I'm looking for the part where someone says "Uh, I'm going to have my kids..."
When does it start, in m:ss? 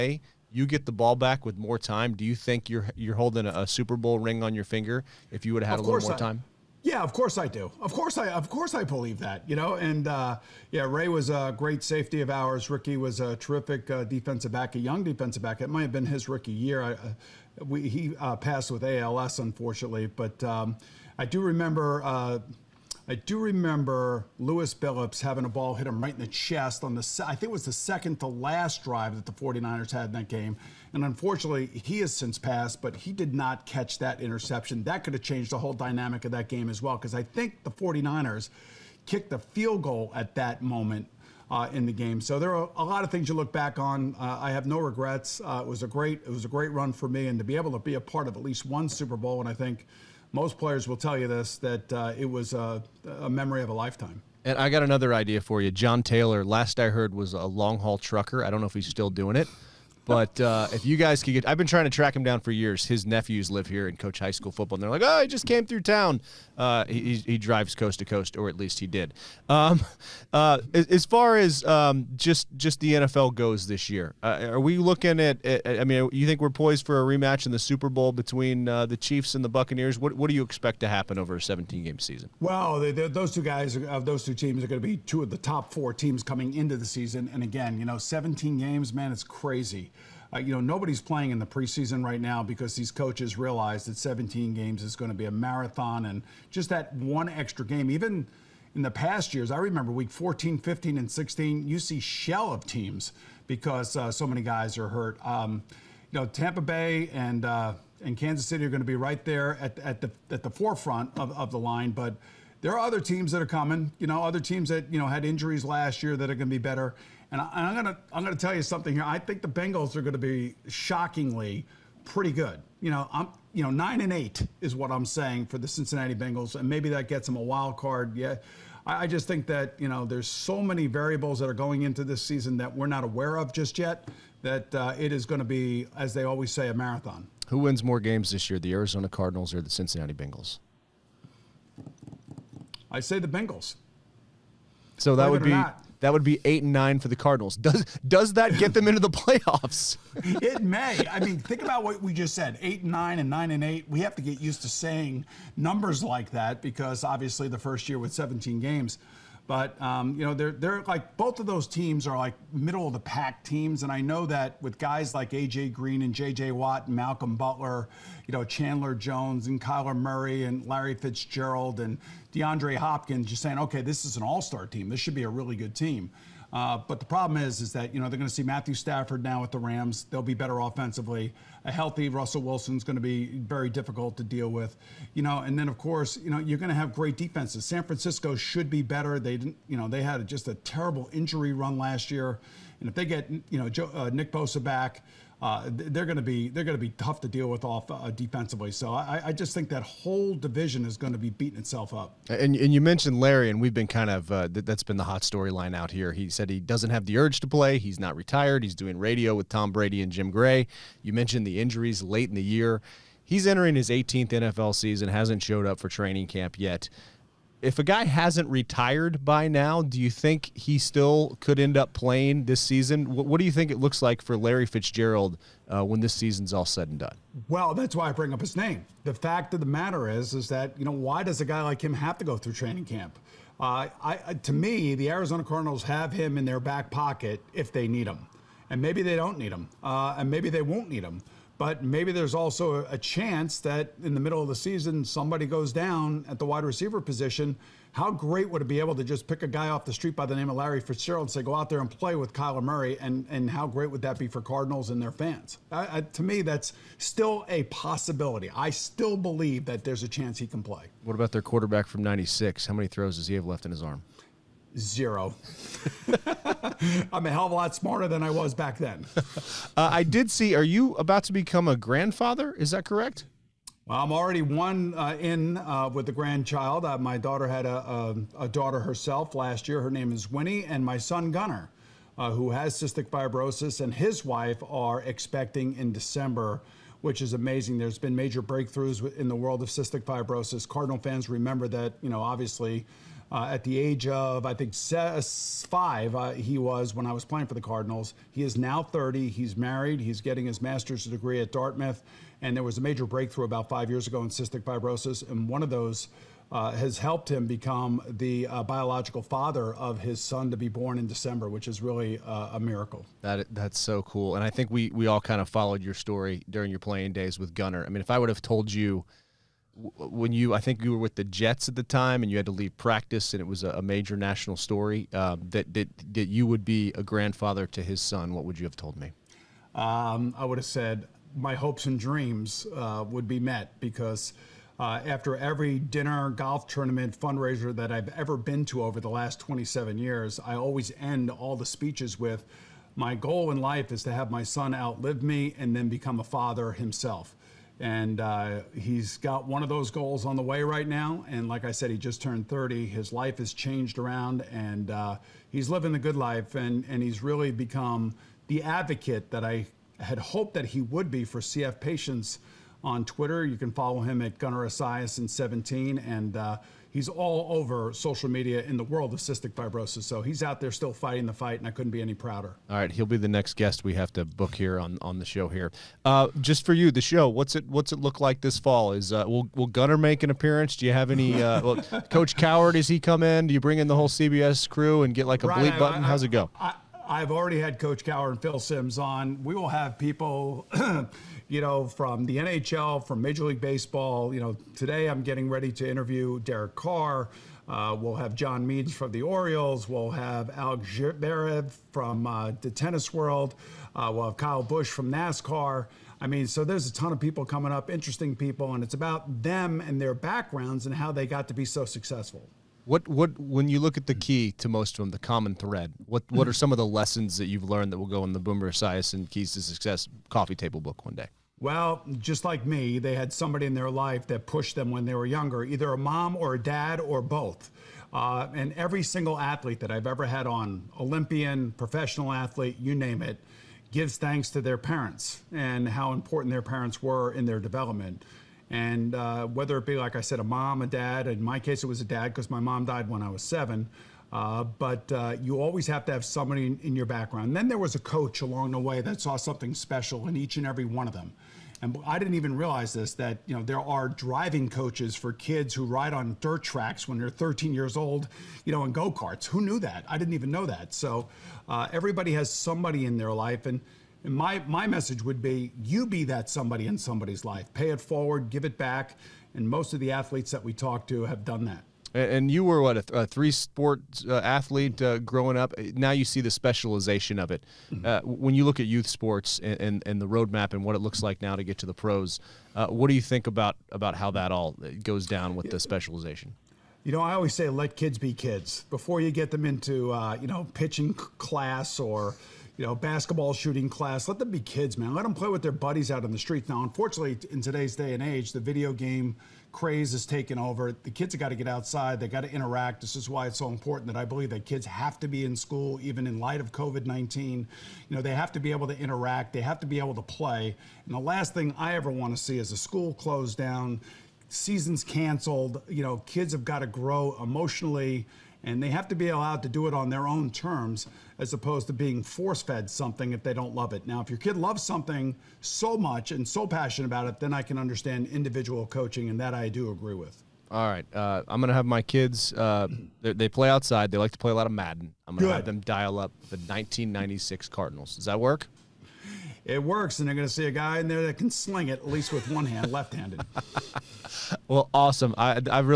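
8:51.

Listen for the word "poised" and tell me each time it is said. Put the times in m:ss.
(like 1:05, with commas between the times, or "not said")
1:16.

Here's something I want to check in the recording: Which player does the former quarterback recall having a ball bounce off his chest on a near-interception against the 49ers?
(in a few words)
Lewis Billups.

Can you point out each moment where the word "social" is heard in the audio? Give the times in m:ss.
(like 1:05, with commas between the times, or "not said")
6:07.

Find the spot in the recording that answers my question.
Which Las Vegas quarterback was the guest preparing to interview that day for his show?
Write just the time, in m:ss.
6:36.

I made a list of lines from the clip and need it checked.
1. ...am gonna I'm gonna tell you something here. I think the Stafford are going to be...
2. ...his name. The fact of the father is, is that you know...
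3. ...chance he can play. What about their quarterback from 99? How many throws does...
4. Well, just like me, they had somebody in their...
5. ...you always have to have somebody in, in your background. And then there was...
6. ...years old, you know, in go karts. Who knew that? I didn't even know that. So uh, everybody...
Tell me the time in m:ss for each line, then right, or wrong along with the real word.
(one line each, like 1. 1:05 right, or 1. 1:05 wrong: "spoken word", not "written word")
1. 1:57 wrong: "Bengals", not "Stafford"
2. 3:48 wrong: "matter", not "father"
3. 4:20 wrong: "96", not "99"
4. 7:01 right
5. 7:25 right
6. 7:37 right.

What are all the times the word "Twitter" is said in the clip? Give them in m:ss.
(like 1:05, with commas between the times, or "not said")
6:03.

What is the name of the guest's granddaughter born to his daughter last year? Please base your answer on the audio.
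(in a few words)
Winnie.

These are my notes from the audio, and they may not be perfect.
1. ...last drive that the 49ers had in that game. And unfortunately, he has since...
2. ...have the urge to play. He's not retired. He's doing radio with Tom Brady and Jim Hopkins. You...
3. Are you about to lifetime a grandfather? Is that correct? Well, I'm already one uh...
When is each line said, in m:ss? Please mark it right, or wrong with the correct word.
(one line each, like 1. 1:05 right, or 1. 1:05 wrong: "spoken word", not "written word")
1. 0:28 right
2. 3:26 wrong: "Gray", not "Hopkins"
3. 4:30 wrong: "become", not "lifetime".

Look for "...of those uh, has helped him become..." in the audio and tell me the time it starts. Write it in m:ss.
5:05.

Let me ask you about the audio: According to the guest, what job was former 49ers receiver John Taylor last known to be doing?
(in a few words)
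long haul trucker.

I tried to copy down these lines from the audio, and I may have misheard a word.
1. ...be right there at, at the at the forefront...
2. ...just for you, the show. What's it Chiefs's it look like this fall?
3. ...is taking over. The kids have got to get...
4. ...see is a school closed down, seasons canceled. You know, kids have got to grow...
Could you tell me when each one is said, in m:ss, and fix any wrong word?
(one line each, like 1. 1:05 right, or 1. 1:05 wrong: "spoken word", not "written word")
1. 1:48 right
2. 6:16 wrong: "What", not "Chiefs"
3. 8:20 right
4. 8:32 right.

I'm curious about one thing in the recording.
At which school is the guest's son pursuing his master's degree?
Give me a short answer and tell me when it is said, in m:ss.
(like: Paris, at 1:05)
Dartmouth, at 5:01.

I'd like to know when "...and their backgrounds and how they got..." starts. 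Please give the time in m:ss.
6:49.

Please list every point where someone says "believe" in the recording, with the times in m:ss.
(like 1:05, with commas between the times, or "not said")
0:08, 4:19, 8:24.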